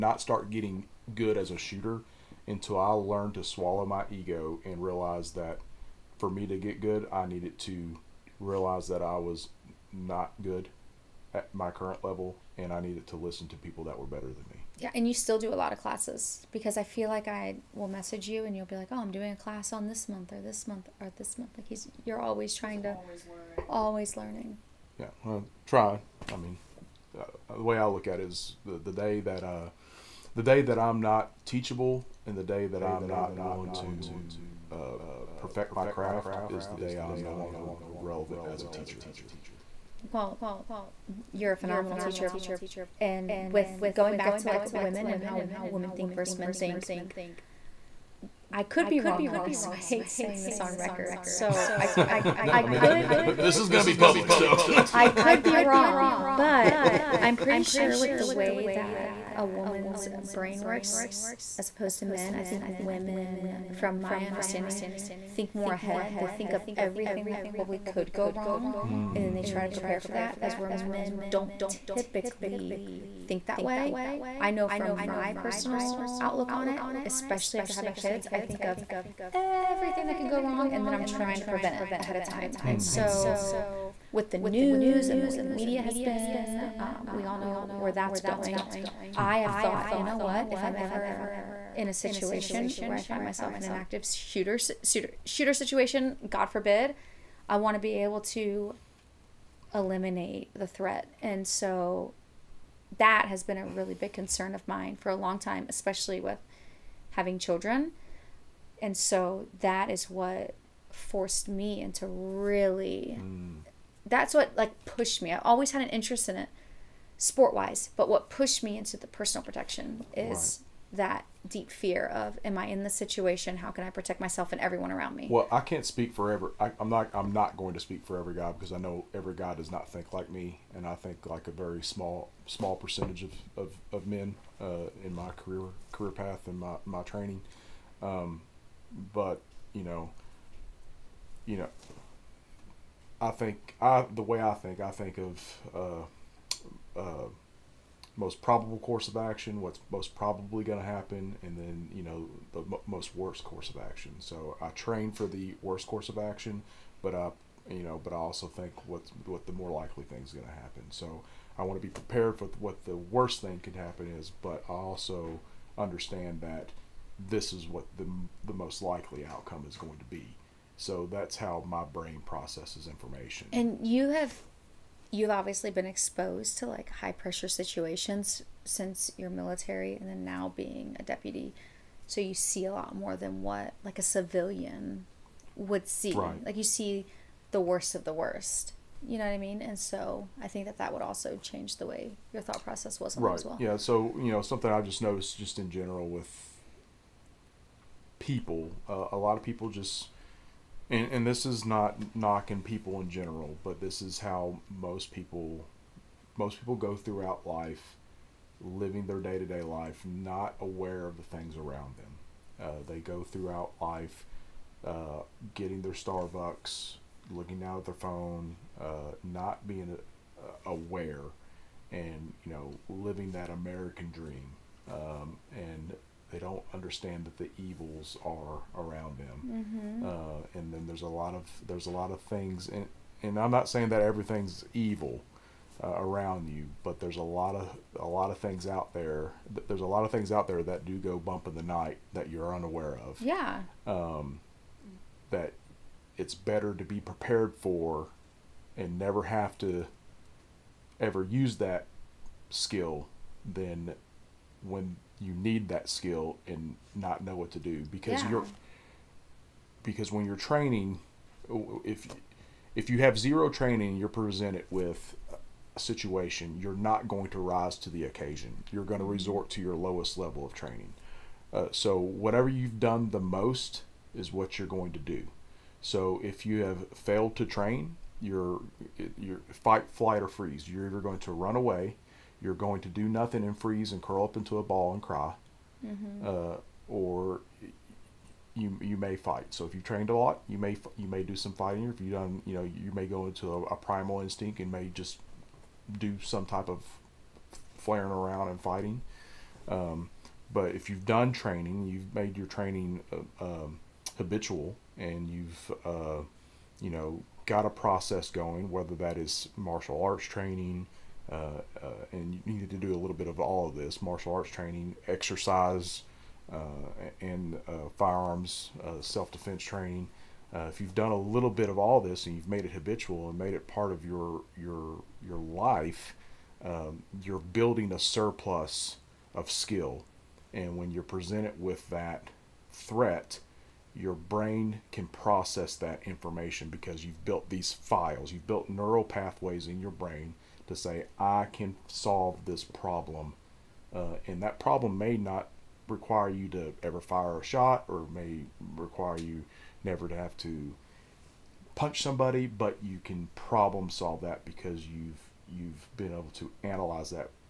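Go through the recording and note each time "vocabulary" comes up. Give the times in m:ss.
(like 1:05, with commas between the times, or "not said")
not said.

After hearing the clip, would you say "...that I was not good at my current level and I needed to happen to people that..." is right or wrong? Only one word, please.
wrong.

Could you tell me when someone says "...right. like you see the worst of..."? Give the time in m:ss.
3:06.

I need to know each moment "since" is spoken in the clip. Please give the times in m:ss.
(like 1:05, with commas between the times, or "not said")
2:58.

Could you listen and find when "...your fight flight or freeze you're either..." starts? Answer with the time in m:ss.
4:39.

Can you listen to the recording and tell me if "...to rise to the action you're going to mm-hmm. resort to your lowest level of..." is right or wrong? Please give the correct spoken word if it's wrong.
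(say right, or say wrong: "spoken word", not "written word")
wrong: "occasion", not "action".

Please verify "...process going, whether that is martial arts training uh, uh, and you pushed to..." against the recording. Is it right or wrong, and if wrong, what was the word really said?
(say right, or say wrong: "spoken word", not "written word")
wrong: "needed", not "pushed".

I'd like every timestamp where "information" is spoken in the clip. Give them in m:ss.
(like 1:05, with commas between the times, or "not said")
2:52, 5:36.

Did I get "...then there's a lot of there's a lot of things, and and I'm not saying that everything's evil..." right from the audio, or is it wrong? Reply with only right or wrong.
right.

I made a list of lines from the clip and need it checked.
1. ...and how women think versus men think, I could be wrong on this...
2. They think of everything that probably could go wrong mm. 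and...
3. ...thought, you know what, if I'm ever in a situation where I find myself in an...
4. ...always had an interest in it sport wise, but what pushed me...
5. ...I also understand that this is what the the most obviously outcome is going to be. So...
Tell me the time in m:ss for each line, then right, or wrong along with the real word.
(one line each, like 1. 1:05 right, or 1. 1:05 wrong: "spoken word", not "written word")
1. 0:45 right
2. 1:06 right
3. 1:29 right
4. 1:55 right
5. 2:44 wrong: "likely", not "obviously".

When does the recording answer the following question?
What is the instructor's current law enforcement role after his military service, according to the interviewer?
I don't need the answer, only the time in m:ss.
3:01.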